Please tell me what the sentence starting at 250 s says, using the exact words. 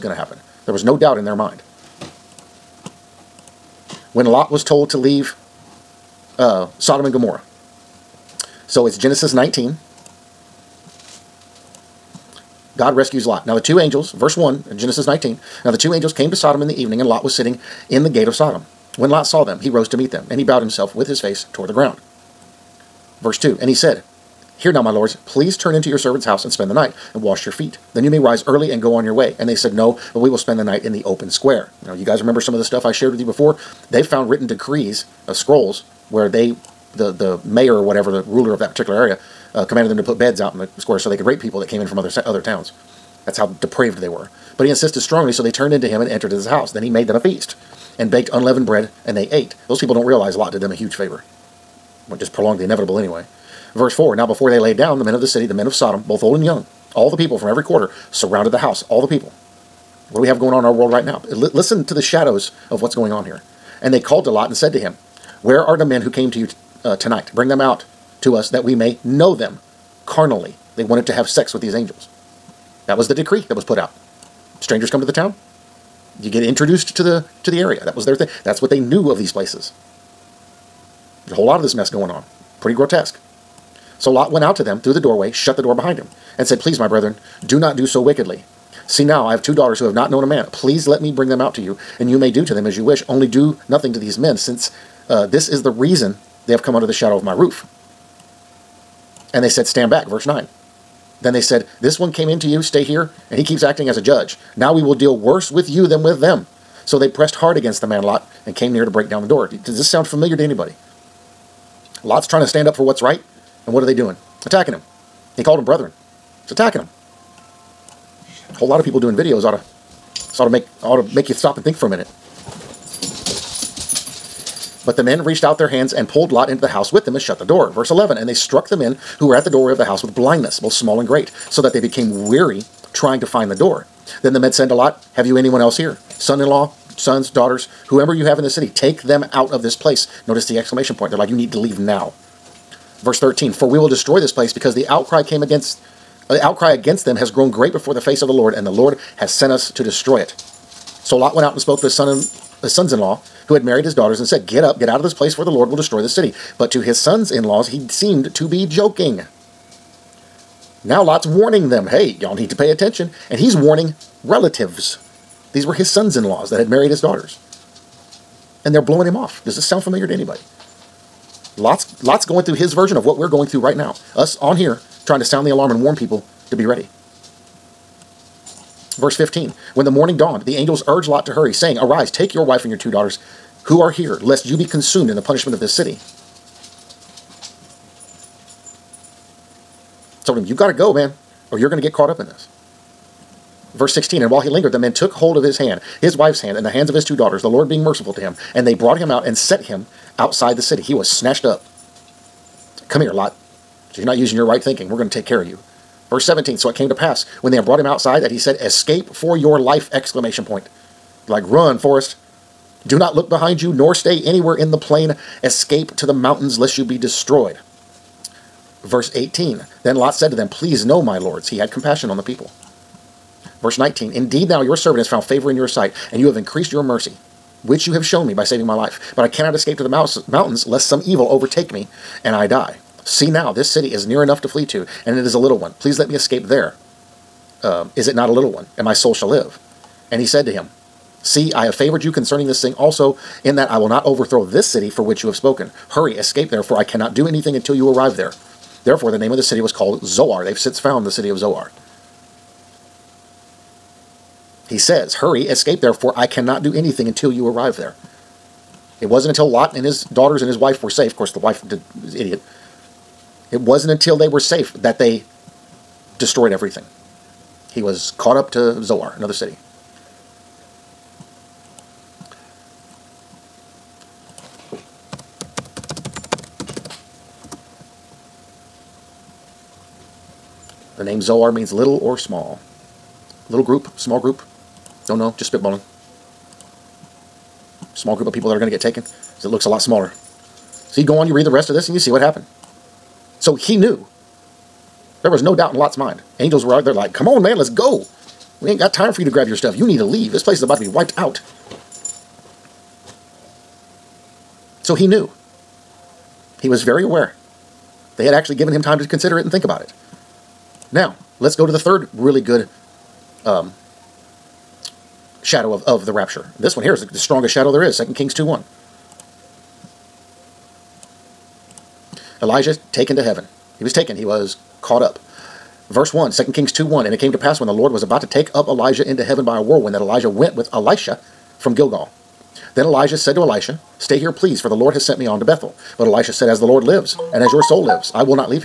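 They've since found the city of Zoar.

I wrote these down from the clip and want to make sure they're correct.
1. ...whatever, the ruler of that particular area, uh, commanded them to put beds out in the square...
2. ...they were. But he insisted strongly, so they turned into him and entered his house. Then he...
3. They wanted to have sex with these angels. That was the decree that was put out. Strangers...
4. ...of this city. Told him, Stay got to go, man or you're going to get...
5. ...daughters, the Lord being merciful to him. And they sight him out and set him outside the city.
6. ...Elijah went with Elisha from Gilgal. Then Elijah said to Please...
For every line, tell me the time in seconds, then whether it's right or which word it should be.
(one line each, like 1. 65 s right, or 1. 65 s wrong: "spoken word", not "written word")
1. 37 s right
2. 43 s right
3. 70 s right
4. 185 s wrong: "You", not "Stay"
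5. 197 s wrong: "brought", not "sight"
6. 329 s wrong: "Elisha", not "Please".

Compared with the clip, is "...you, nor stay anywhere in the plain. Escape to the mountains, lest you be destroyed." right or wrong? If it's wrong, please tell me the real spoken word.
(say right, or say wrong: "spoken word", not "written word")
right.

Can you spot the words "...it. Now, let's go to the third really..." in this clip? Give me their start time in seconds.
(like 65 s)
309 s.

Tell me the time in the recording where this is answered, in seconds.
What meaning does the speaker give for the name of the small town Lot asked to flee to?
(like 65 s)
281 s.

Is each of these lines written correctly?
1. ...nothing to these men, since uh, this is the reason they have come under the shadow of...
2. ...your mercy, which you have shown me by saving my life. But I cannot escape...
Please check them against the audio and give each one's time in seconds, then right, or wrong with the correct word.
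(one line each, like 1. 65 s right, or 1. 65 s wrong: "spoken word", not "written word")
1. 93 s right
2. 226 s right.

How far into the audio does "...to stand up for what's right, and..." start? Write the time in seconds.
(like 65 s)
112 s.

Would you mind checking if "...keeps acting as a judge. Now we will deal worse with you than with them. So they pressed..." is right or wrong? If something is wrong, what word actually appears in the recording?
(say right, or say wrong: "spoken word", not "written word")
right.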